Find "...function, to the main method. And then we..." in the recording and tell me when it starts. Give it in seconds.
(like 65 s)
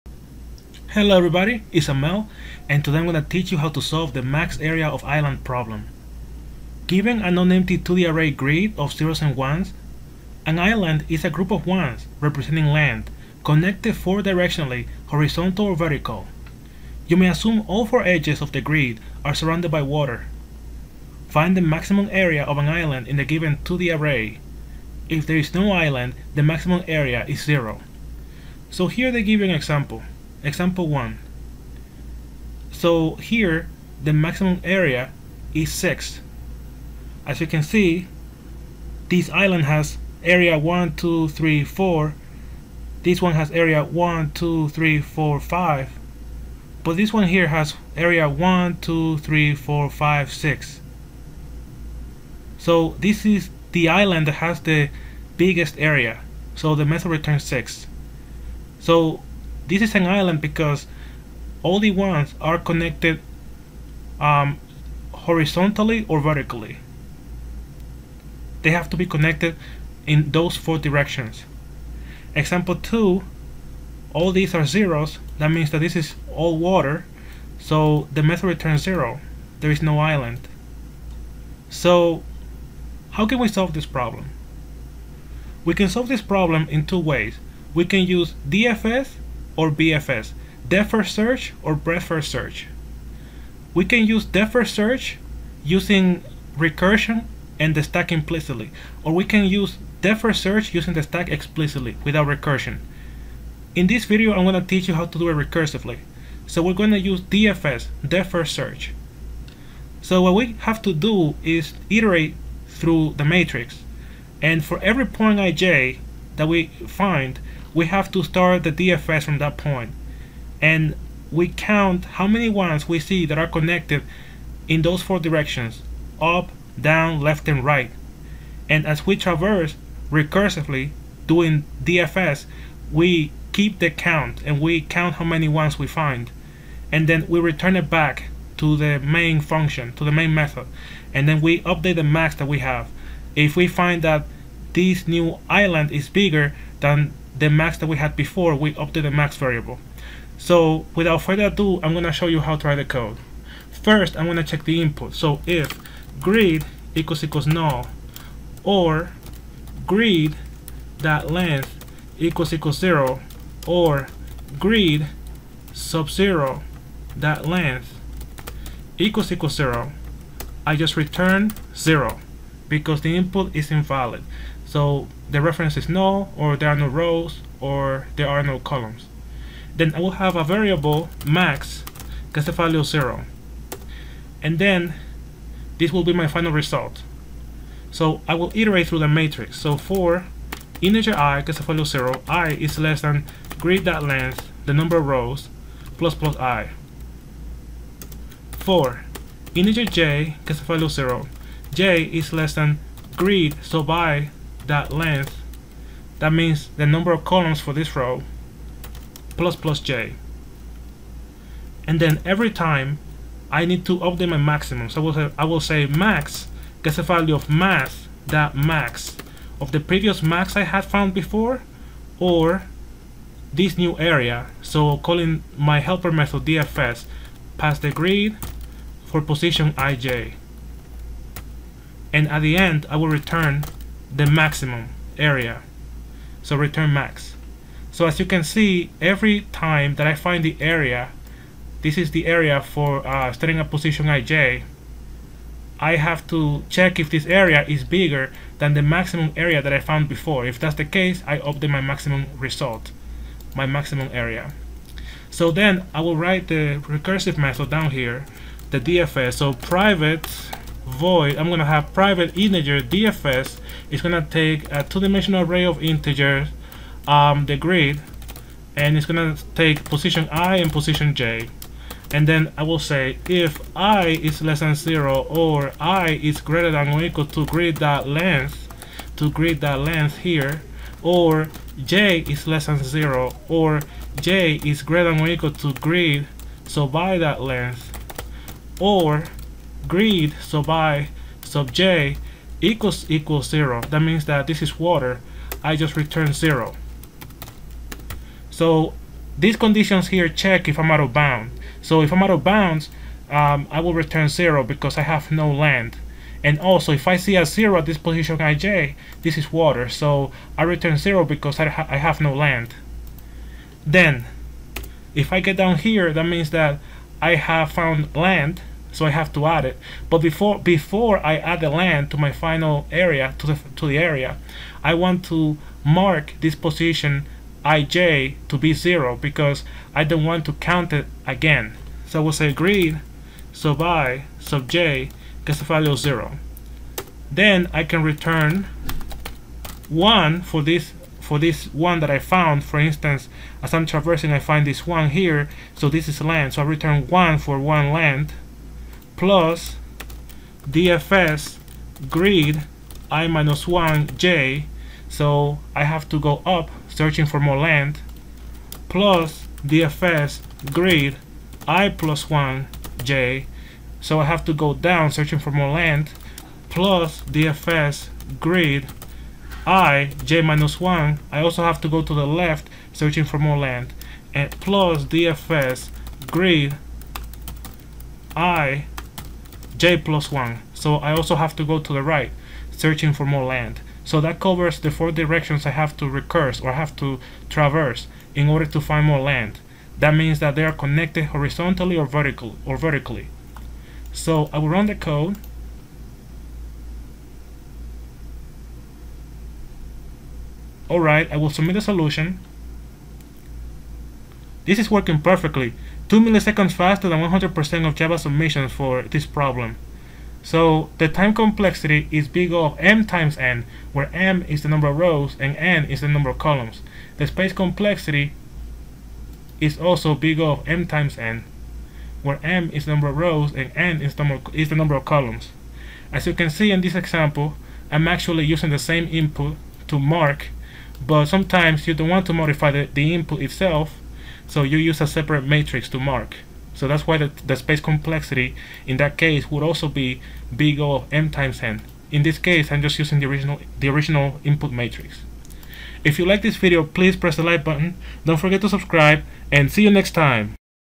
139 s.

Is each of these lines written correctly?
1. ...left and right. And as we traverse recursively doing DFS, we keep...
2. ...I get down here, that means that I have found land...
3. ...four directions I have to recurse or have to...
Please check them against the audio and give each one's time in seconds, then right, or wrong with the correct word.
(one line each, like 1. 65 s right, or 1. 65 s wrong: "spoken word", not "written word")
1. 127 s right
2. 315 s right
3. 384 s right.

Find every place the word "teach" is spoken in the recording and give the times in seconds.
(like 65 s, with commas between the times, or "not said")
3 s, 104 s.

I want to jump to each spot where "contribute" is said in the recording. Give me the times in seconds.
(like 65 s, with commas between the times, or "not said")
not said.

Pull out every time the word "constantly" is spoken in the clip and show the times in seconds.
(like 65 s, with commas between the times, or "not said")
not said.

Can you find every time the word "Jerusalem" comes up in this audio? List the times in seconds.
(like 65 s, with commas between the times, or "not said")
not said.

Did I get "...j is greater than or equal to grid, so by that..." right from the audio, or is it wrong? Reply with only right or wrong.
right.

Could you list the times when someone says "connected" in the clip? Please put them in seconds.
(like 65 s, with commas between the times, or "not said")
13 s, 62 s, 69 s, 123 s, 390 s.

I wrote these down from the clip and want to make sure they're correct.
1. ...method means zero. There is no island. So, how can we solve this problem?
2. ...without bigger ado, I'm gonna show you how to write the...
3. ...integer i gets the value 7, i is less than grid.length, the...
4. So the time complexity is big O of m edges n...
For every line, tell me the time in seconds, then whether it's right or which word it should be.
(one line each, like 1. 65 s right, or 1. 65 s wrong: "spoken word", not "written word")
1. 78 s wrong: "returns", not "means"
2. 150 s wrong: "further", not "bigger"
3. 190 s wrong: "0", not "7"
4. 410 s wrong: "times", not "edges".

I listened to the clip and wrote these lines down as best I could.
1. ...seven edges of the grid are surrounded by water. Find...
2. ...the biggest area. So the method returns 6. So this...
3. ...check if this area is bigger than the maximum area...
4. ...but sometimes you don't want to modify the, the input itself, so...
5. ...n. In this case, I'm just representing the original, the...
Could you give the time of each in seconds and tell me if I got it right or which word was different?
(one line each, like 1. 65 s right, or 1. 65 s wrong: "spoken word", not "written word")
1. 17 s wrong: "four", not "seven"
2. 54 s right
3. 246 s right
4. 431 s right
5. 441 s wrong: "using", not "representing".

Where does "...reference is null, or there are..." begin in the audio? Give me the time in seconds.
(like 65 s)
175 s.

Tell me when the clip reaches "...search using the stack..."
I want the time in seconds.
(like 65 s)
100 s.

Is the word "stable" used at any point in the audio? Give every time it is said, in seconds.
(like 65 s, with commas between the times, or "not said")
not said.